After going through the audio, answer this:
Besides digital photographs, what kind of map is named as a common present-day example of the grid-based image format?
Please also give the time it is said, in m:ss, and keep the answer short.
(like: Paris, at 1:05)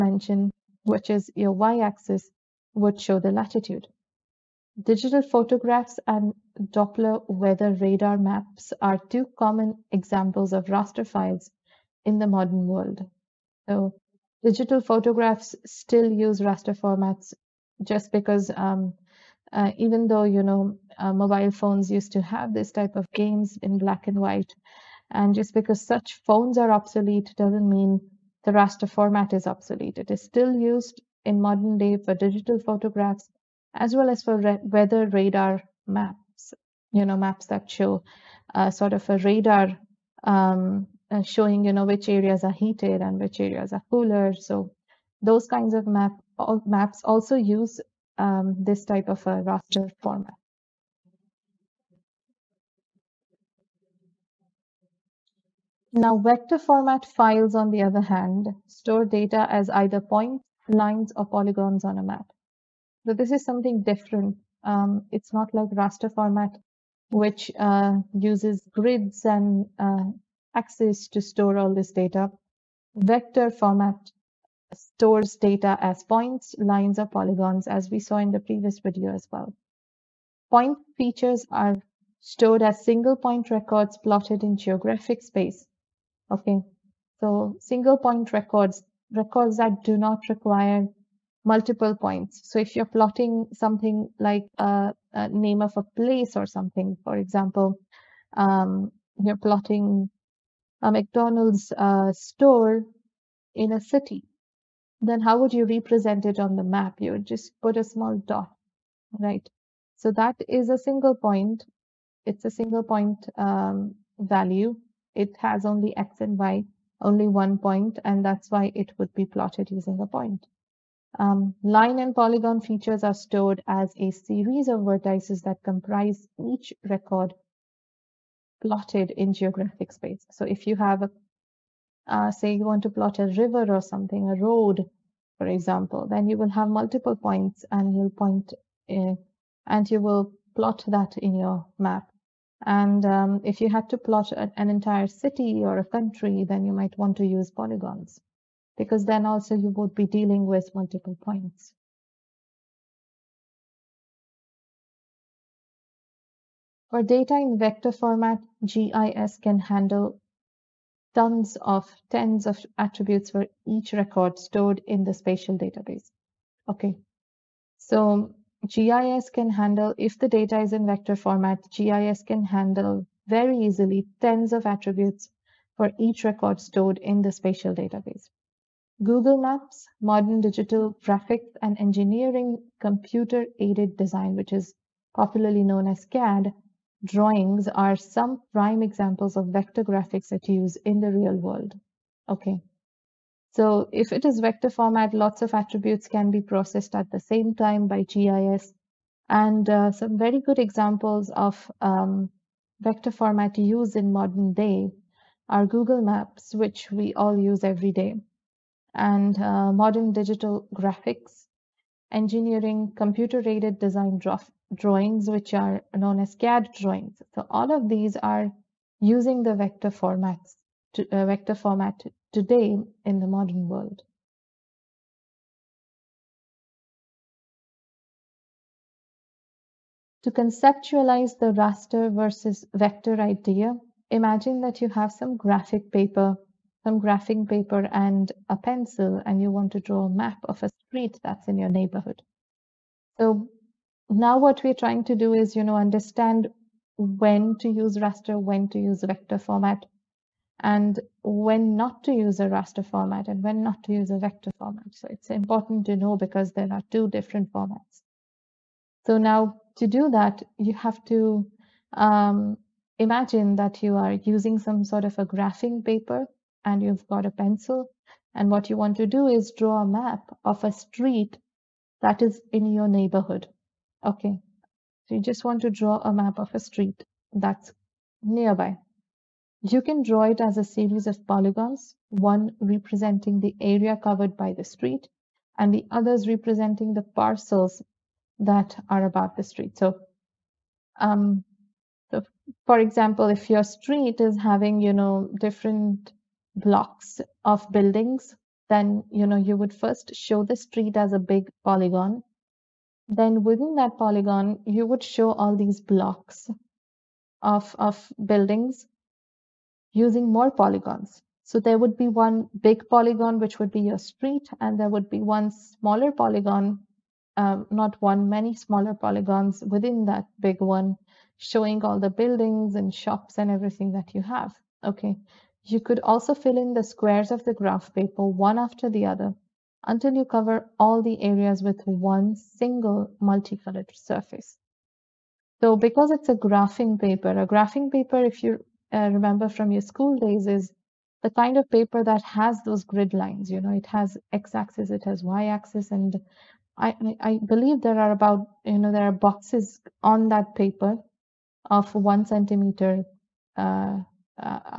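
Doppler weather radar maps, at 0:06.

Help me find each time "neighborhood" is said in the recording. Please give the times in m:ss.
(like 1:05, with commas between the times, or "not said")
4:01, 4:32.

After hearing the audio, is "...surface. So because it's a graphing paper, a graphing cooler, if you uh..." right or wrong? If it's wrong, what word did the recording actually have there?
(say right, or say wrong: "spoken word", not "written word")
wrong: "paper", not "cooler".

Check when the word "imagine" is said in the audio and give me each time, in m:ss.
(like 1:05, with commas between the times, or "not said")
3:54, 4:22.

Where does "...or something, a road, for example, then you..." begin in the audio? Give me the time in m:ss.
2:13.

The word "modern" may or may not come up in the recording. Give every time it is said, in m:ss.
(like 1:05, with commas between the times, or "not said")
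0:12, 0:31, 3:00, 3:24, 3:29, 3:43.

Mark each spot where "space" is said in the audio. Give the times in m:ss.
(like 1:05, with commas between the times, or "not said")
1:25, 2:09.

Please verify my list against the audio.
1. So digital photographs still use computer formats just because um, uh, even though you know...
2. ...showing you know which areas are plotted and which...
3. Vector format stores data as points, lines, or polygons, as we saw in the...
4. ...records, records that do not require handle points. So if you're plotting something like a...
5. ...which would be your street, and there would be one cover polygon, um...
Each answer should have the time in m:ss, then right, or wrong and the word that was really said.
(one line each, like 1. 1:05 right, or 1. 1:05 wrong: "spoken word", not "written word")
1. 0:13 wrong: "raster", not "computer"
2. 0:41 wrong: "heated", not "plotted"
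3. 1:12 right
4. 1:28 wrong: "multiple", not "handle"
5. 5:13 wrong: "smaller", not "cover".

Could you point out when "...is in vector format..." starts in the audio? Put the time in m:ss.
2:50.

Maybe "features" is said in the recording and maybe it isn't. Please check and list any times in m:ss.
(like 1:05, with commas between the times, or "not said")
1:20, 2:02.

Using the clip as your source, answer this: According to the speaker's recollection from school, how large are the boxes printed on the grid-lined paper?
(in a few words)
1 centimeter.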